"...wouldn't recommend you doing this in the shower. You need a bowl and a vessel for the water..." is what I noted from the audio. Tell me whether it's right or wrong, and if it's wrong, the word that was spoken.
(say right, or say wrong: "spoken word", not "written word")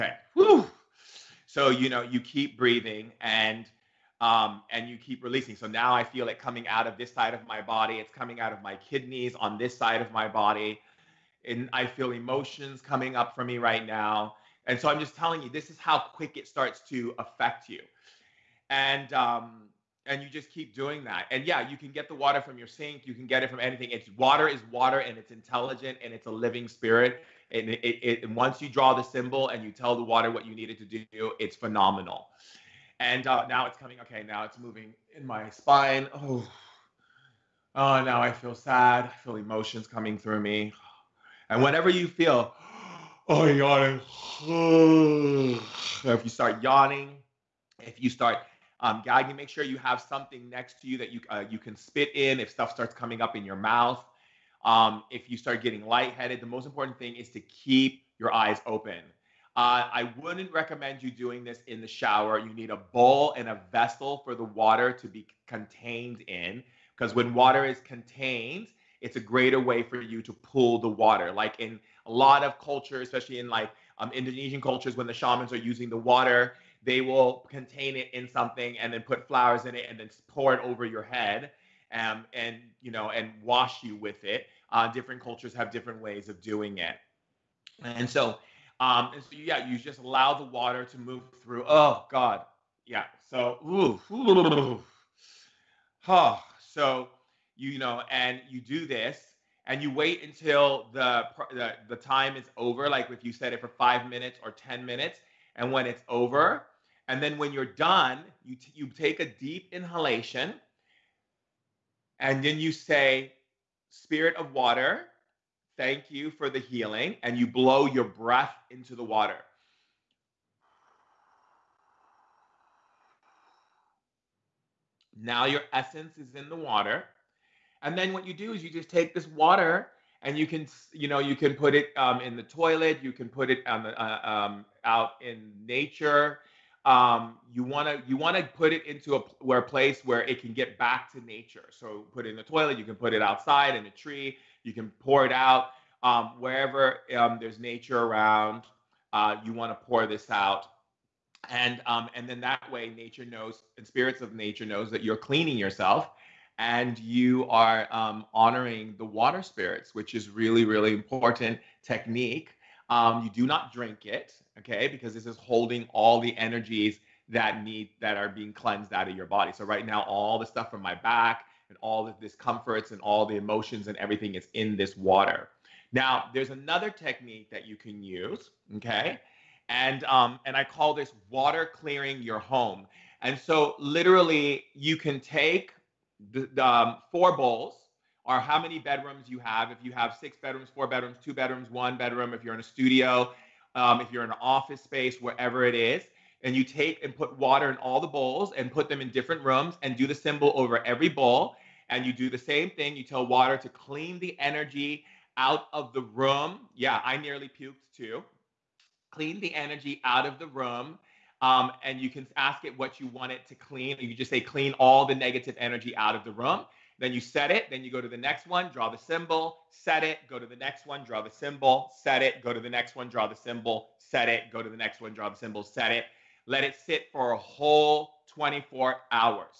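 right.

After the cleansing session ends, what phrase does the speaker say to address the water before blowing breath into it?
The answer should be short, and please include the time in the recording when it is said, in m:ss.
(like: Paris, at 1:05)
Spirit of water, at 1:53.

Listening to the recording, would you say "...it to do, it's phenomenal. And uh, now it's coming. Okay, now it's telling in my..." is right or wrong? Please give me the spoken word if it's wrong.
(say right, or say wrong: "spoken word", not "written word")
wrong: "moving", not "telling".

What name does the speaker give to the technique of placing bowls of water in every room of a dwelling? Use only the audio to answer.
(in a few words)
water clearing your home.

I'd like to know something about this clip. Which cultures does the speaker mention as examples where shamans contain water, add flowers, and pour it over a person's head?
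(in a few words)
Indonesian.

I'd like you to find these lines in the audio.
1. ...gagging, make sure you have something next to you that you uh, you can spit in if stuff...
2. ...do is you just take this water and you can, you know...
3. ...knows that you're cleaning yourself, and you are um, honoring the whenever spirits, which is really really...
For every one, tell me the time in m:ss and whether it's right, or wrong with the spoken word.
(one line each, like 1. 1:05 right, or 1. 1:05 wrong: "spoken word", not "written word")
1. 0:49 right
2. 2:08 right
3. 2:34 wrong: "water", not "whenever".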